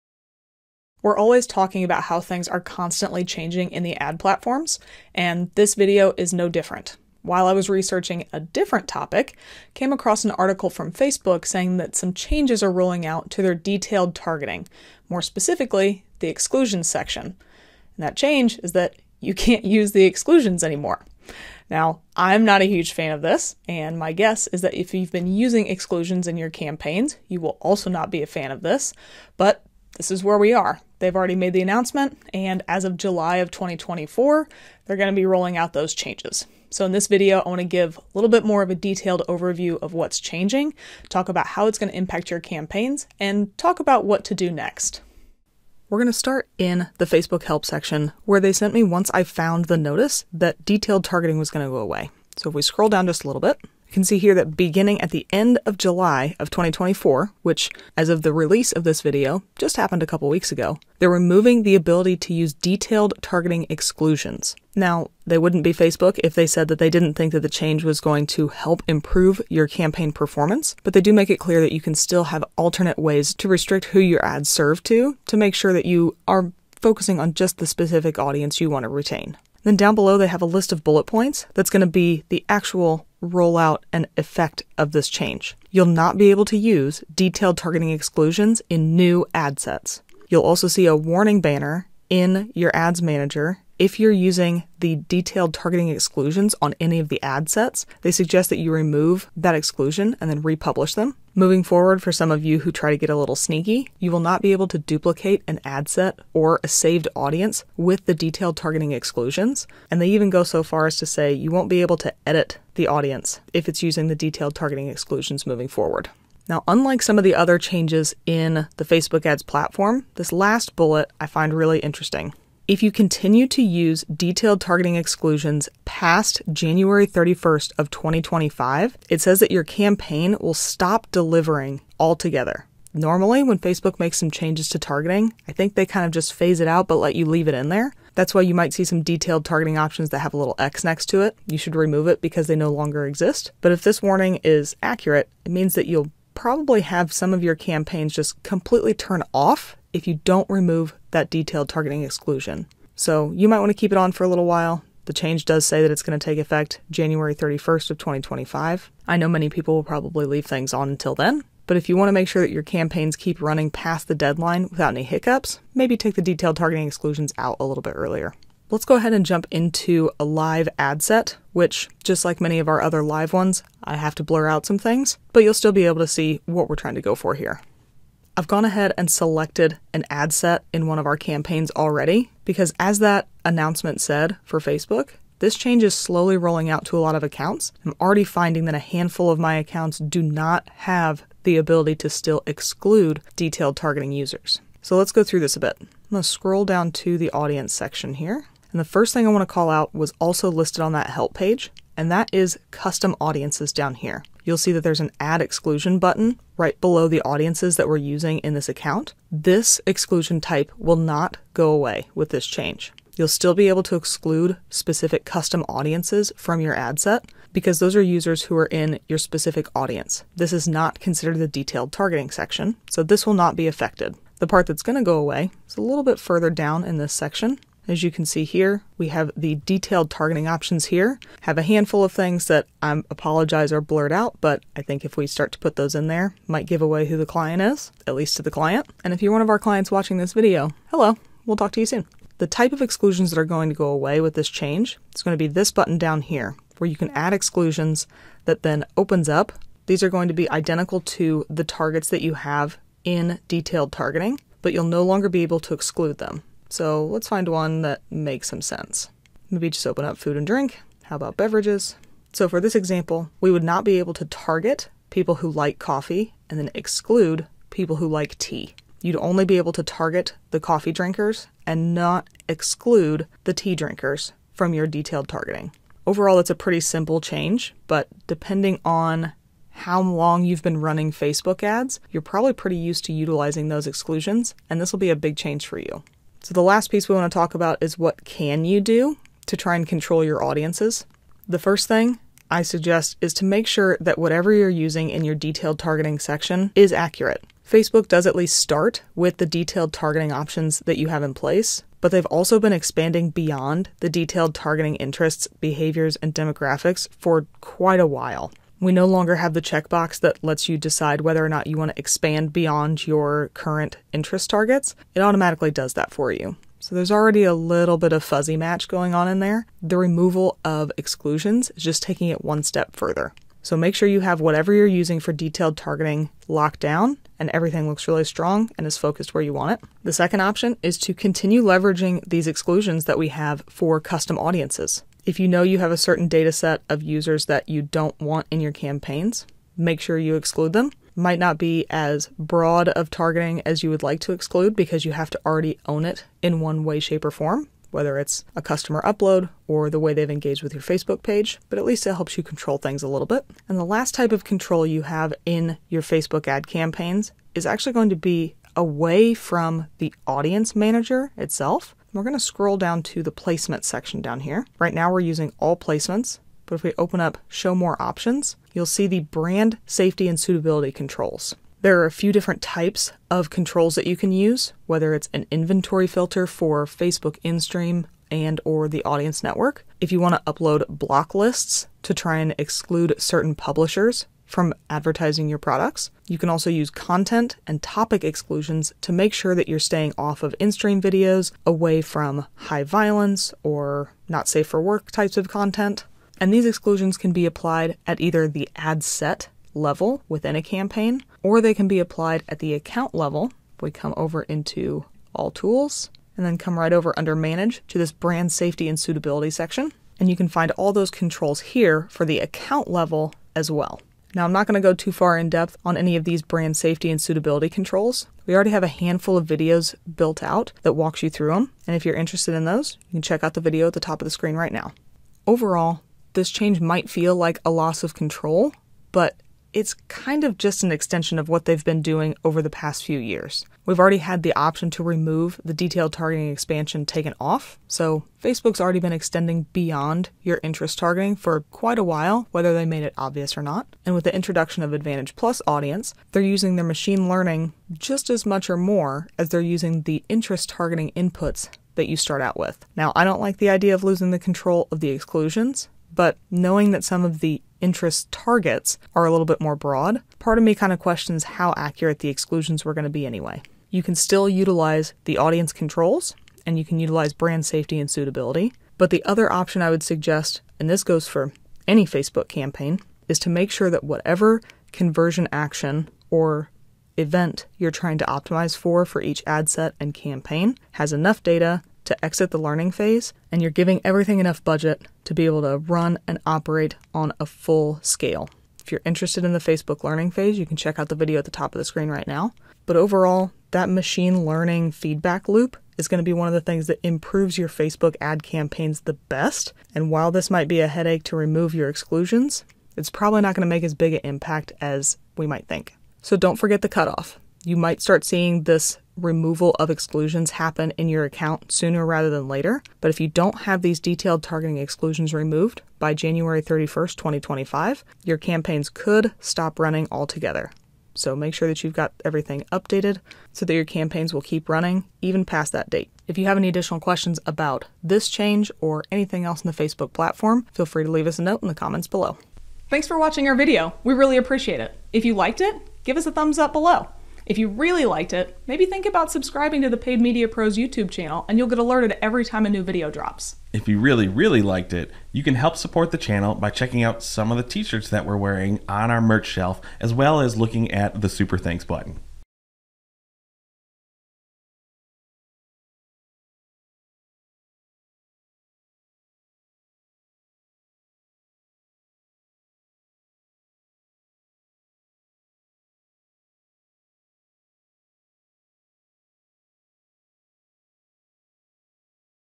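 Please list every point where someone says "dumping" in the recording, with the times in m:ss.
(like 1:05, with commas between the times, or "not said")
not said.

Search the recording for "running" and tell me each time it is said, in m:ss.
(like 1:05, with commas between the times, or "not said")
2:43, 4:40, 8:39, 8:44.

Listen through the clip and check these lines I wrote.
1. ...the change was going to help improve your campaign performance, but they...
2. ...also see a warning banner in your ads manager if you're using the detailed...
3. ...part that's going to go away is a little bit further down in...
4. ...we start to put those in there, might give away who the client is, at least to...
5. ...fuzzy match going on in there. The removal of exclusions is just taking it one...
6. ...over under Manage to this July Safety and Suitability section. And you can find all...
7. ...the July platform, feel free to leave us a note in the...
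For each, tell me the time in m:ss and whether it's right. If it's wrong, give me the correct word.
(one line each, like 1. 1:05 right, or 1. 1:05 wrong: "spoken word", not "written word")
1. 1:07 right
2. 1:30 right
3. 3:44 right
4. 3:55 right
5. 5:18 right
6. 6:46 wrong: "Brand", not "July"
7. 8:49 wrong: "Facebook", not "July".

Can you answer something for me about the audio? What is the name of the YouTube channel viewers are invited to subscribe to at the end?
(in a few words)
Paid Media Pros.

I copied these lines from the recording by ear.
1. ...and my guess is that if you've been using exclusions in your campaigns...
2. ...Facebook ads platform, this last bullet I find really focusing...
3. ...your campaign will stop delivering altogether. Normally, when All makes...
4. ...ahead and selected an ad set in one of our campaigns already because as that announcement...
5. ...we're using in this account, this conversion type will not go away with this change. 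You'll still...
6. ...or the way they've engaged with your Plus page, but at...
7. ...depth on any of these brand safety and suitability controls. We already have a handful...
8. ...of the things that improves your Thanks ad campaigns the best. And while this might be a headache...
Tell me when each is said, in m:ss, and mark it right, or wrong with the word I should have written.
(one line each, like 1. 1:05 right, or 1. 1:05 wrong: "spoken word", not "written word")
1. 0:23 right
2. 1:58 wrong: "interesting", not "focusing"
3. 2:09 wrong: "Facebook", not "All"
4. 2:58 right
5. 3:27 wrong: "exclusion", not "conversion"
6. 5:49 wrong: "Facebook", not "Plus"
7. 6:55 right
8. 8:16 wrong: "Facebook", not "Thanks".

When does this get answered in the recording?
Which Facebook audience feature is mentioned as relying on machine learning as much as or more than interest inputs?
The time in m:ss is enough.
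7:24.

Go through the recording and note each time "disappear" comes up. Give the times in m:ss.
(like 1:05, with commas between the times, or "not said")
not said.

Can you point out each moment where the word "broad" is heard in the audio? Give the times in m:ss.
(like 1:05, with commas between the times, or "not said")
5:42, 7:39.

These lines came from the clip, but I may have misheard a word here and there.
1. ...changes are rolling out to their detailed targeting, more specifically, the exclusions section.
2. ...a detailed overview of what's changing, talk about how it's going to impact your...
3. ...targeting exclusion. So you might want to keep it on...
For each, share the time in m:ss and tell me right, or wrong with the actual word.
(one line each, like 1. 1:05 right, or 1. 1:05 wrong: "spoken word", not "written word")
1. 0:12 right
2. 0:38 right
3. 2:31 right.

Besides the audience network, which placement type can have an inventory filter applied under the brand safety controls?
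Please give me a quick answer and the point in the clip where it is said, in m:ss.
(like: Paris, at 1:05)
Facebook InStream, at 6:16.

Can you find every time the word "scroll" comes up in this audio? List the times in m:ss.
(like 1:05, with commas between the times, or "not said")
0:52, 3:16, 6:02.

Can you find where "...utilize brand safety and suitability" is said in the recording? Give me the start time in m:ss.
7:46.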